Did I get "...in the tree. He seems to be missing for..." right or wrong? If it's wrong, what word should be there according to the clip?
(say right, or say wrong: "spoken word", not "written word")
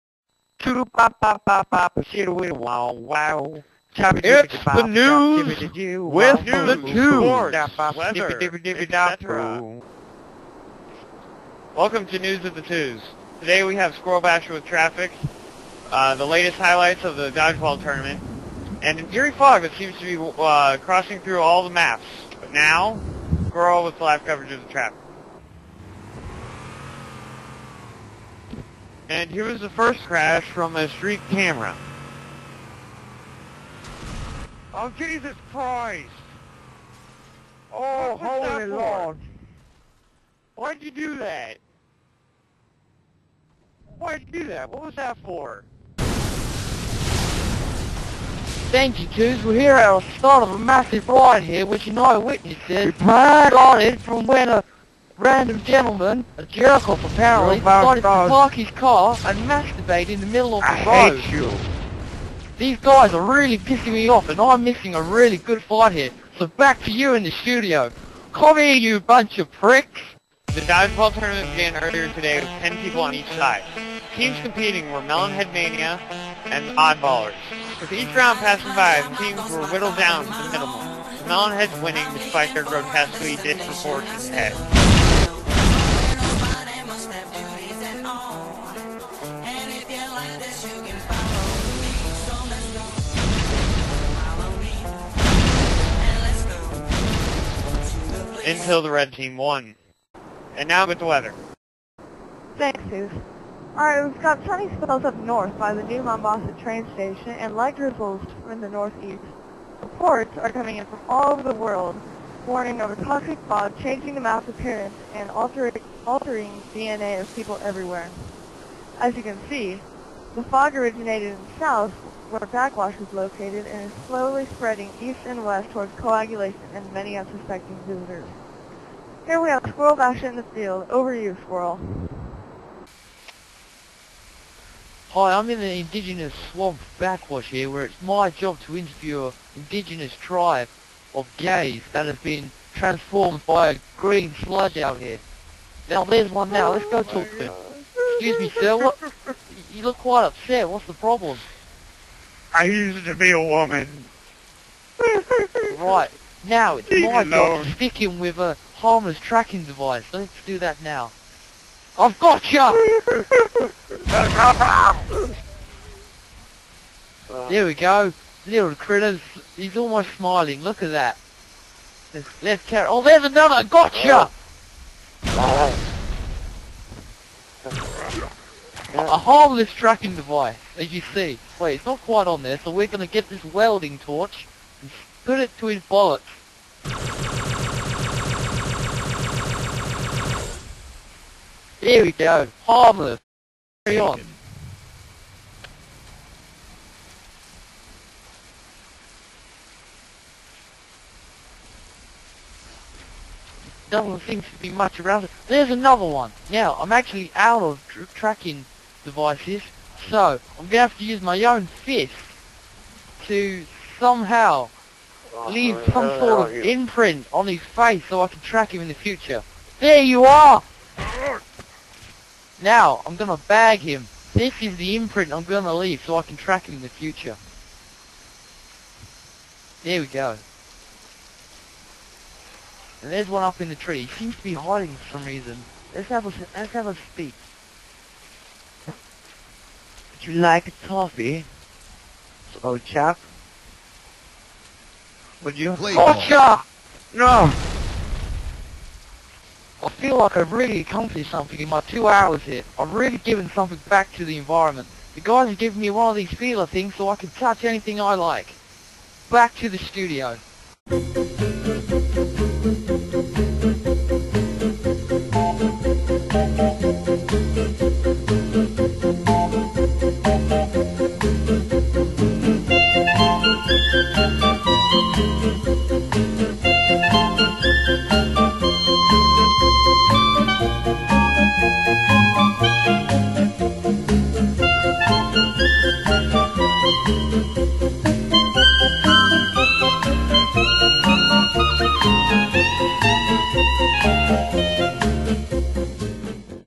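wrong: "hiding", not "missing".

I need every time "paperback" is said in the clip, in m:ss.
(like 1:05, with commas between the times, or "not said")
not said.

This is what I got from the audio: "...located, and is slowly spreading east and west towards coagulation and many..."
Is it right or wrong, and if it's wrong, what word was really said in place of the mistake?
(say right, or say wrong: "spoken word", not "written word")
right.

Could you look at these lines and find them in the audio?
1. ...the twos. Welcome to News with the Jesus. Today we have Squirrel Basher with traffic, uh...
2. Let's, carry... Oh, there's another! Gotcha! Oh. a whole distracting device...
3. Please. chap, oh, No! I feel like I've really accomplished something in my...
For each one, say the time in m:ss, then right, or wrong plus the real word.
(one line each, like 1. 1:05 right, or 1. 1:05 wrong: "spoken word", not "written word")
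1. 0:06 wrong: "Twos", not "Jesus"
2. 2:52 right
3. 4:05 right.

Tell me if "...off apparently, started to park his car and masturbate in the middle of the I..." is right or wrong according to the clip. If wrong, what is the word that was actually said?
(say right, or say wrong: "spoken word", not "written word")
right.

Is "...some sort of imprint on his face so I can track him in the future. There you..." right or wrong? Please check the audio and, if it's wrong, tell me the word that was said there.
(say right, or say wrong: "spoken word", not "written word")
right.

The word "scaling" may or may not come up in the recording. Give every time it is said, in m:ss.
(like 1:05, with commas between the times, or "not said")
not said.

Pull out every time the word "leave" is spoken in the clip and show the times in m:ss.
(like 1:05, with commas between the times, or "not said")
2:36, 3:35, 3:45.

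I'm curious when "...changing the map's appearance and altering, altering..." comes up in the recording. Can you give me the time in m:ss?
1:53.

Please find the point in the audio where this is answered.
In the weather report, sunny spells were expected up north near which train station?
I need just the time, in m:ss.
1:45.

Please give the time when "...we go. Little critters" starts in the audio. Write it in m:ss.
2:47.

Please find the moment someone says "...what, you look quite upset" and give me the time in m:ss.
2:28.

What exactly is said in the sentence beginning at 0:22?
But now, Squirrel with live coverage of the traffic.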